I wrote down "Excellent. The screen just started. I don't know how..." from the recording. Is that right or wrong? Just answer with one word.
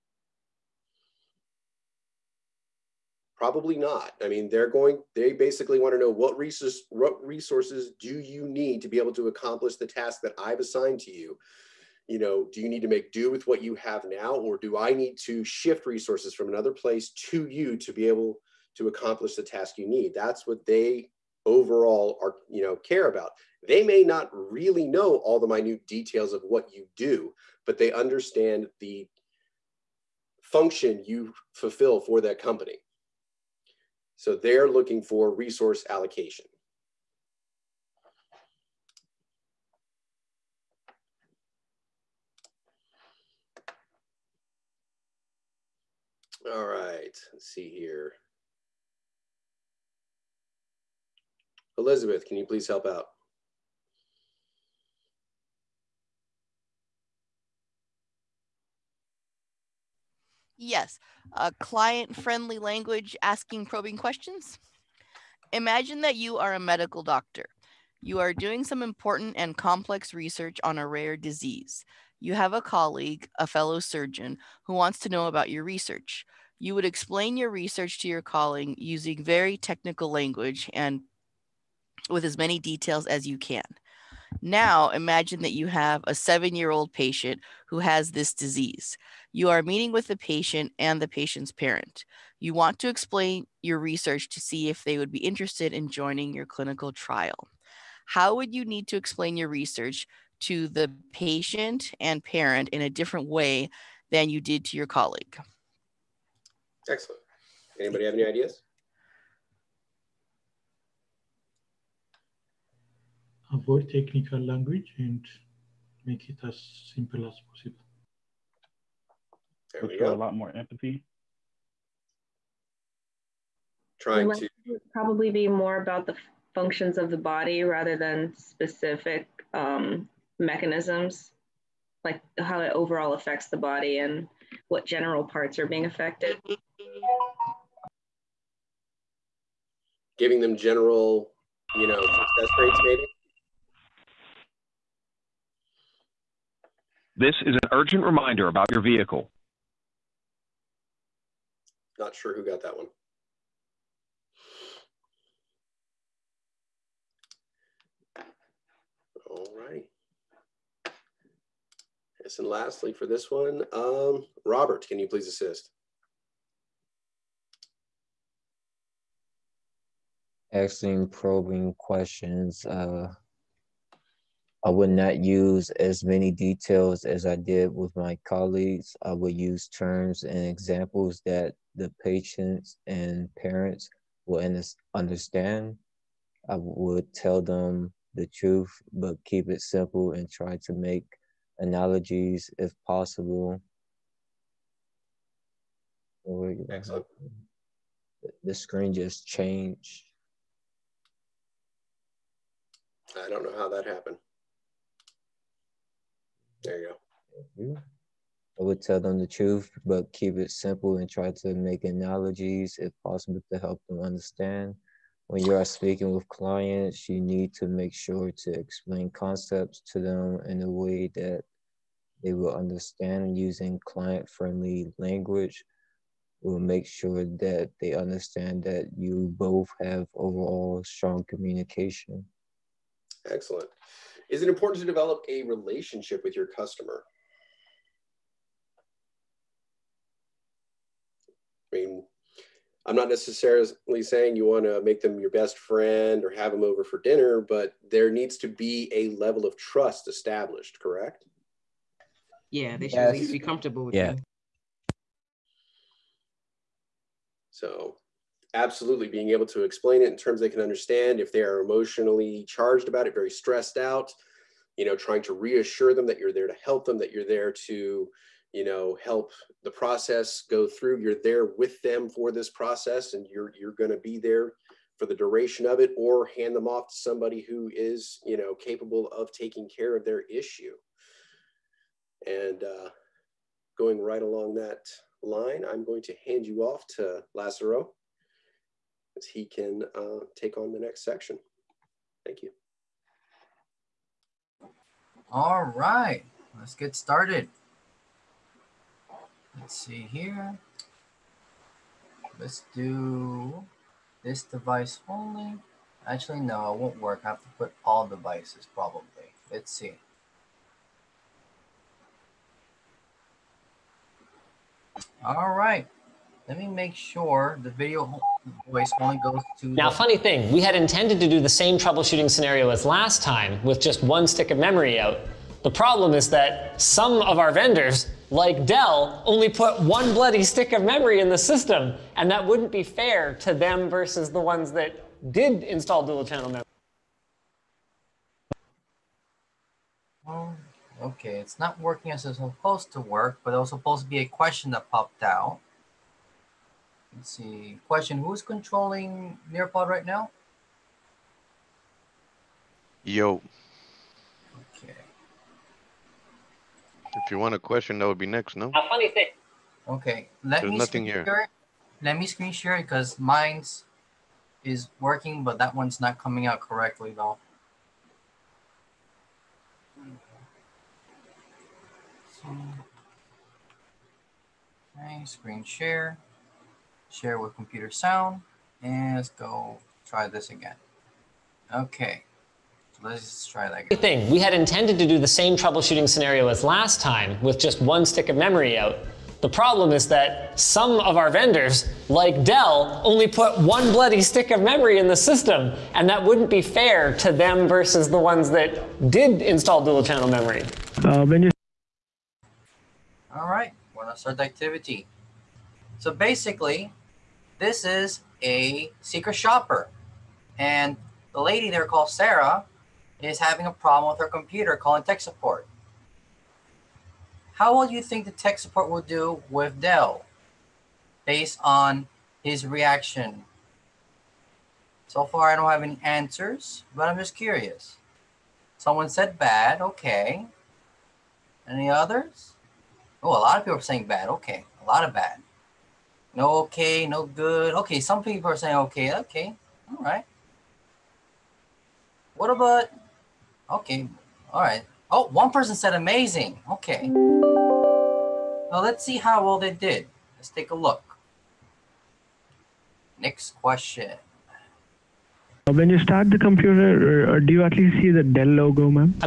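wrong.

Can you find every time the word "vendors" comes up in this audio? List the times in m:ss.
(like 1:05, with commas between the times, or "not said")
5:27, 6:31.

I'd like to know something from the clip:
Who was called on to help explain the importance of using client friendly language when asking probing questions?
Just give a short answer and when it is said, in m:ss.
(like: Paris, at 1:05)
Elizabeth, at 0:51.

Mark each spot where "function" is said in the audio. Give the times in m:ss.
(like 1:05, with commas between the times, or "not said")
0:30, 2:06.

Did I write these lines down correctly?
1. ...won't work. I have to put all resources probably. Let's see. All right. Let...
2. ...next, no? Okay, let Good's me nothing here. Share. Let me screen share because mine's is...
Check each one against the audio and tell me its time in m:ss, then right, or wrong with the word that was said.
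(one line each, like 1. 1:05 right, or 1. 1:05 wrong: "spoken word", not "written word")
1. 5:06 wrong: "devices", not "resources"
2. 5:58 wrong: "There", not "Good".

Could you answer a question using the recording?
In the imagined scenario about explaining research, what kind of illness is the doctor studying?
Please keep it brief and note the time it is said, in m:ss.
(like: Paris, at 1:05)
Rare disease, at 1:10.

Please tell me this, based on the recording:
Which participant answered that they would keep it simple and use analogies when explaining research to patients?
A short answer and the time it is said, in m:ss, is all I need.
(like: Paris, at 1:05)
Robert, at 2:44.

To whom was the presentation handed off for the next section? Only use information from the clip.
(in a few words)
Lazaro.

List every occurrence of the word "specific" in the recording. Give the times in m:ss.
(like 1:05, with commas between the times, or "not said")
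2:08.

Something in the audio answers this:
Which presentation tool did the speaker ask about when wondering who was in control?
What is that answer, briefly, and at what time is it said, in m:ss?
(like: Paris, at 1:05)
Nearpod, at 5:49.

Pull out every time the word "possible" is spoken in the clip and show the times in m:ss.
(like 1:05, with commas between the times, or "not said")
1:57, 3:12, 3:33.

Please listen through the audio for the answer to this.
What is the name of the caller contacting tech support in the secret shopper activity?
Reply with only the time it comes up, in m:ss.
6:52.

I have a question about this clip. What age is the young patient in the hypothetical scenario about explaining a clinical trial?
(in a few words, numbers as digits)
7.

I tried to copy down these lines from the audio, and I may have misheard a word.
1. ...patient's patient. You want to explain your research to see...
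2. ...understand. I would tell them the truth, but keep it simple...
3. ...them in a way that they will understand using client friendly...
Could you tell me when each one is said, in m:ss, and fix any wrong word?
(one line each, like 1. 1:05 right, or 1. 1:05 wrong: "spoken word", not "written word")
1. 1:31 wrong: "parent", not "patient"
2. 3:04 right
3. 3:39 right.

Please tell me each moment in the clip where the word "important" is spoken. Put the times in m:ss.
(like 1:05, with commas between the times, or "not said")
1:08, 3:54.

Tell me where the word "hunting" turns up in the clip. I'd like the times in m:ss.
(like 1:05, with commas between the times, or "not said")
not said.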